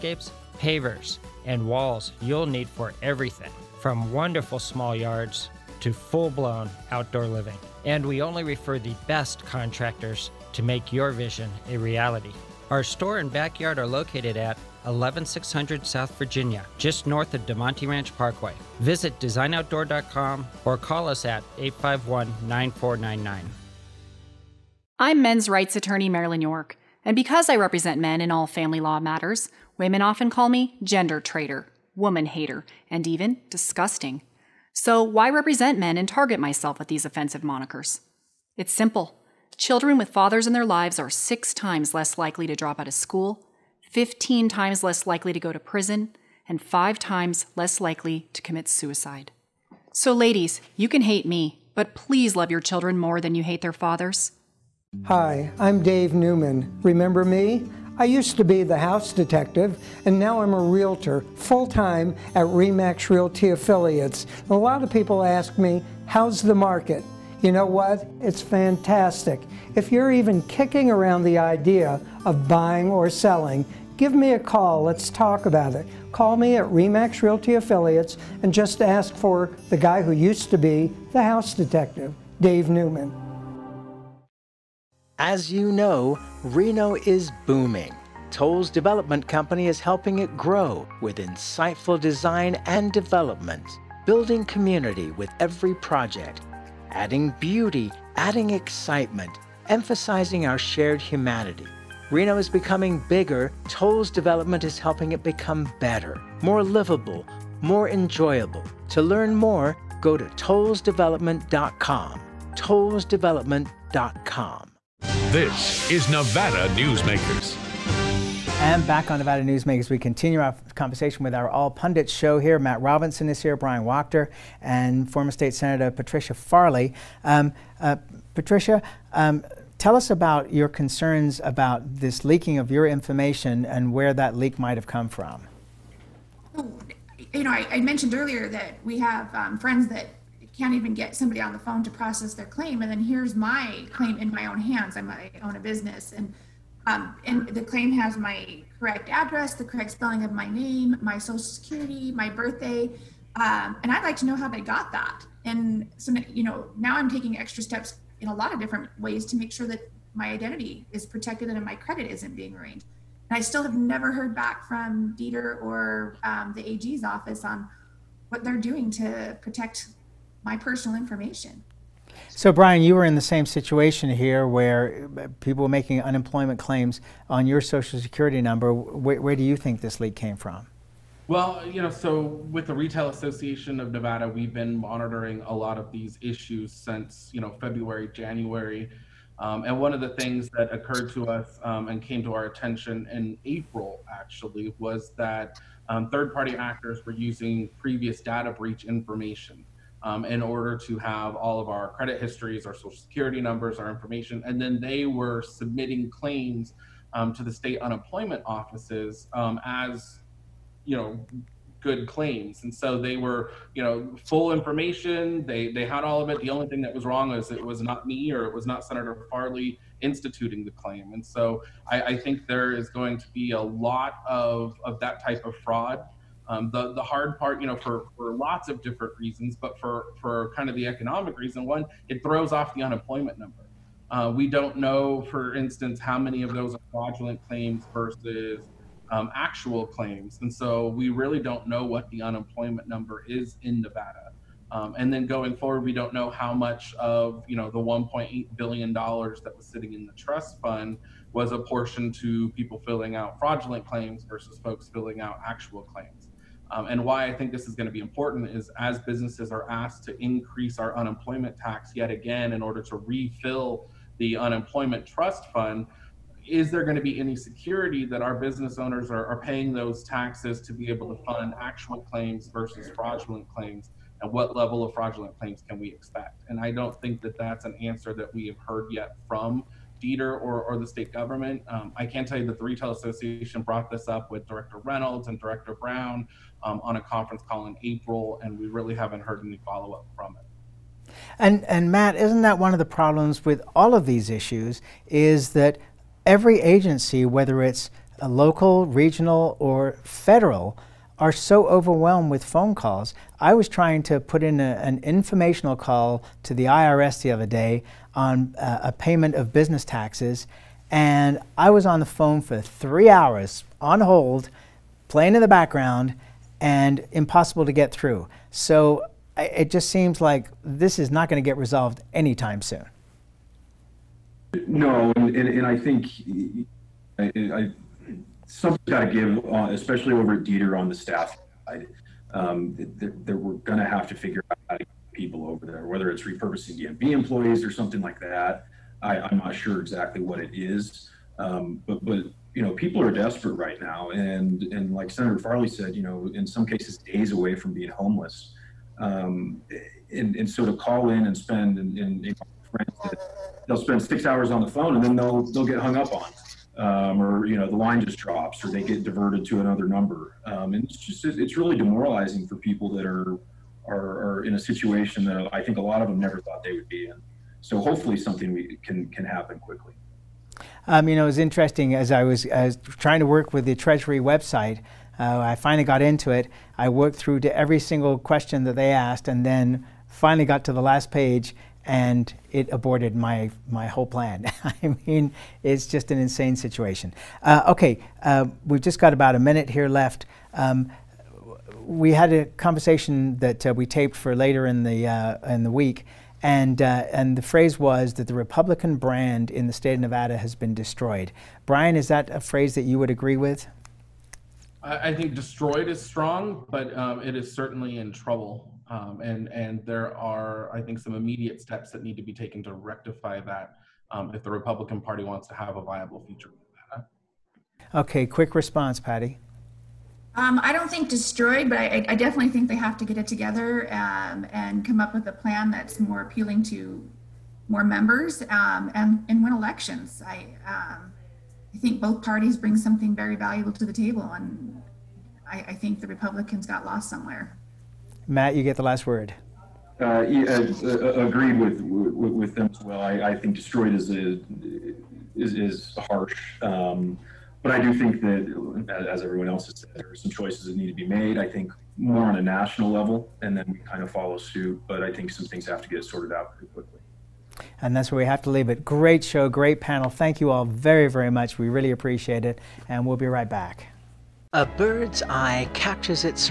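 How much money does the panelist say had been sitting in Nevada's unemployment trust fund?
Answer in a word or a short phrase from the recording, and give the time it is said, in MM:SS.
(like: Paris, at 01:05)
$1.8 billion, at 04:07.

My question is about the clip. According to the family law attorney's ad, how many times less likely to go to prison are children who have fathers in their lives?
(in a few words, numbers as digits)
15.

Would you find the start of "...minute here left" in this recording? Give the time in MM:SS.
06:29.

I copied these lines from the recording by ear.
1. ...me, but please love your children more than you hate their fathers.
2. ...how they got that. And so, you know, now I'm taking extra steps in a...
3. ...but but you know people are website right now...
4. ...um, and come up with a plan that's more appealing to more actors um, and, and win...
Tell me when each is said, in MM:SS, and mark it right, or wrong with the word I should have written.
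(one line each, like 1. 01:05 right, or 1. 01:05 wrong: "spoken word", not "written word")
1. 00:51 right
2. 02:34 right
3. 05:41 wrong: "desperate", not "website"
4. 07:03 wrong: "members", not "actors".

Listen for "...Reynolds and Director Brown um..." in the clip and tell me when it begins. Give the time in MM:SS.
04:44.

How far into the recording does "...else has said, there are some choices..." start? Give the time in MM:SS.
07:29.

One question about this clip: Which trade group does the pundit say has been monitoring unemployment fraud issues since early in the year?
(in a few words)
Retail Association of Nevada.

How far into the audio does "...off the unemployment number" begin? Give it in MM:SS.
03:52.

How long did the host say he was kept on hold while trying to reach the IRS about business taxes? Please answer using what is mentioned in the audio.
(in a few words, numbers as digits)
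3 hours.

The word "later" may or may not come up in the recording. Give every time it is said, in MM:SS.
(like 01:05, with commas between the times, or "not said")
06:34.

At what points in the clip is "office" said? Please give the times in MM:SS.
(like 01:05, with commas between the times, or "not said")
02:47, 03:28.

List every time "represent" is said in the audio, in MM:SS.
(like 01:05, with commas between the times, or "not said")
00:27, 00:35.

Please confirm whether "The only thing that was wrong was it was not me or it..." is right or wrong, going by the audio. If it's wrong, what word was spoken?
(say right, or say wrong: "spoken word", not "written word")
right.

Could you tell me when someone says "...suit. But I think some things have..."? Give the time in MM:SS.
07:34.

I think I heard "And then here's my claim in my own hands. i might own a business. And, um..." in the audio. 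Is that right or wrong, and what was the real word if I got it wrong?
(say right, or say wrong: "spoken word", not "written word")
right.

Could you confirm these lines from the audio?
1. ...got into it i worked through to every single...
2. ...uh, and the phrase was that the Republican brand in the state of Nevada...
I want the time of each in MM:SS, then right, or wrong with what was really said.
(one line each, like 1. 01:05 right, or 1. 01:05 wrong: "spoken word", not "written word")
1. 06:15 right
2. 06:36 right.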